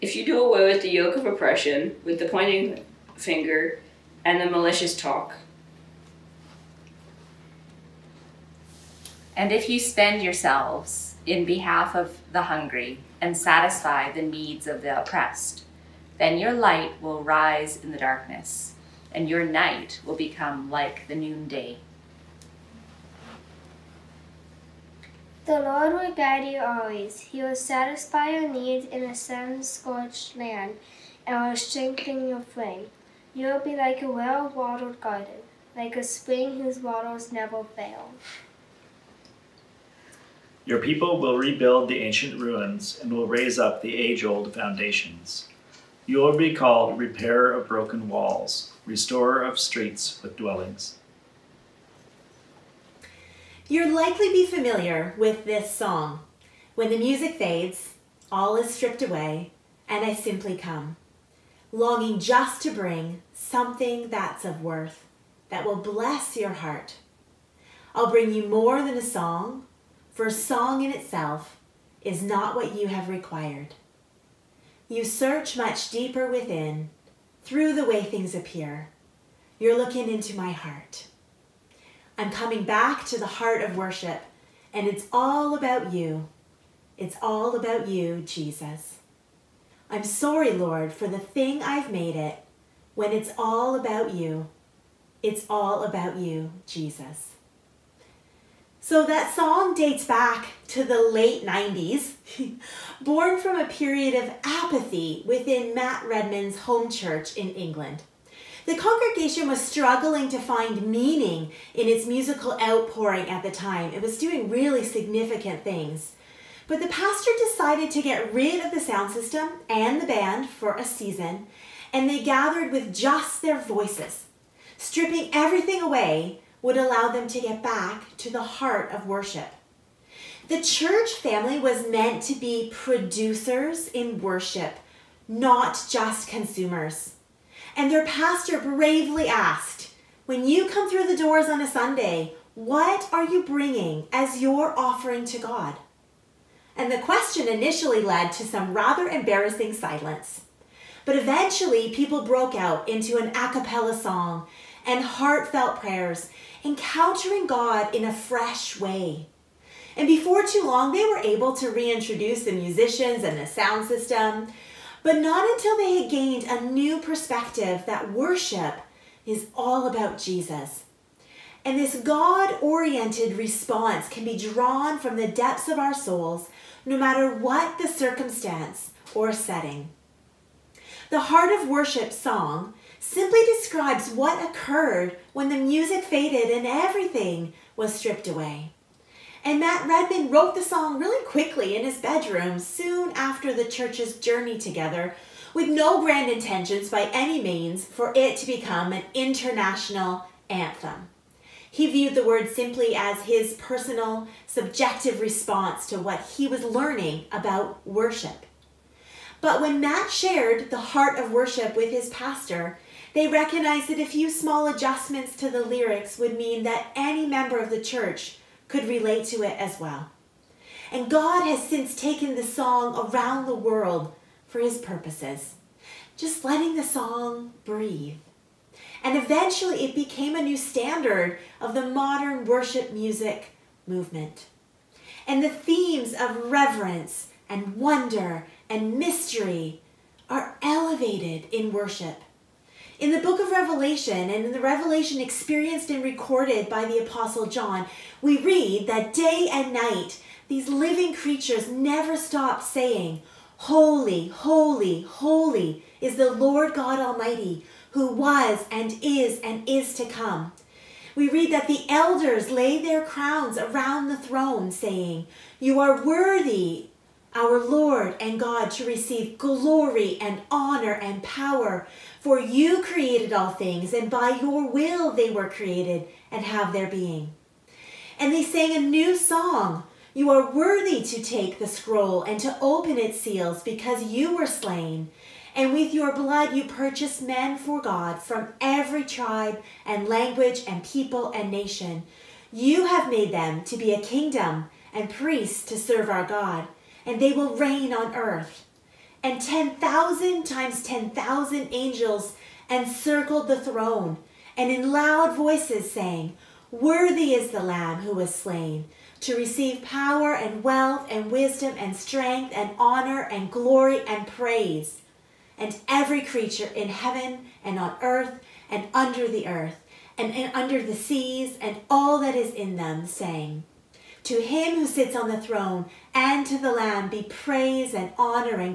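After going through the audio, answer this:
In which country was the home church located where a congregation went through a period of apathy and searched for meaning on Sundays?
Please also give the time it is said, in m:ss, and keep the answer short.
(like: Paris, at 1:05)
England, at 1:47.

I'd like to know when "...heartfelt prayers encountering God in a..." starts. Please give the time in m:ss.
2:35.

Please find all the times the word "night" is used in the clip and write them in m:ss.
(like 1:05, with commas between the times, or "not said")
0:19, 4:09.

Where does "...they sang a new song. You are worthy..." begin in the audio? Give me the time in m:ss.
4:38.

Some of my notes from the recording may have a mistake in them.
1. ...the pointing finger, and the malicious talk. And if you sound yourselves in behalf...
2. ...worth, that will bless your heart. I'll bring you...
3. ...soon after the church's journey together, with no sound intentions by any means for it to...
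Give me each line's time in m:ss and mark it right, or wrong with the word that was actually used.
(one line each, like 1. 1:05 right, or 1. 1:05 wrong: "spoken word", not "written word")
1. 0:02 wrong: "spend", not "sound"
2. 1:04 right
3. 3:12 wrong: "grand", not "sound".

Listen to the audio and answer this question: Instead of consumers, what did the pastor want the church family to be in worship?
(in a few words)
Producers.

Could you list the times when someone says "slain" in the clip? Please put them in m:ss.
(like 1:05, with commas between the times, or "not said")
4:44, 5:08.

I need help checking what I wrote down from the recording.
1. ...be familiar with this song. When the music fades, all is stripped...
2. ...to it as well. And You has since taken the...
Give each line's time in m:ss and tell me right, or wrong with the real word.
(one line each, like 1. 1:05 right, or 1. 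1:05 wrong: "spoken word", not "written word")
1. 0:54 right
2. 3:39 wrong: "God", not "You".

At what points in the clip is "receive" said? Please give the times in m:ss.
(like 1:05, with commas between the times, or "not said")
4:28, 5:09.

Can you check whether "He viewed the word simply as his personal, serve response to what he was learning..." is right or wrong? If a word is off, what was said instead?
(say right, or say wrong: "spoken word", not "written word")
wrong: "subjective", not "serve".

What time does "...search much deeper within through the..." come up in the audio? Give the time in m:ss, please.
1:15.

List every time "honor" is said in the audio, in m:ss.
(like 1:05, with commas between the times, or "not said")
4:30, 5:12, 5:28.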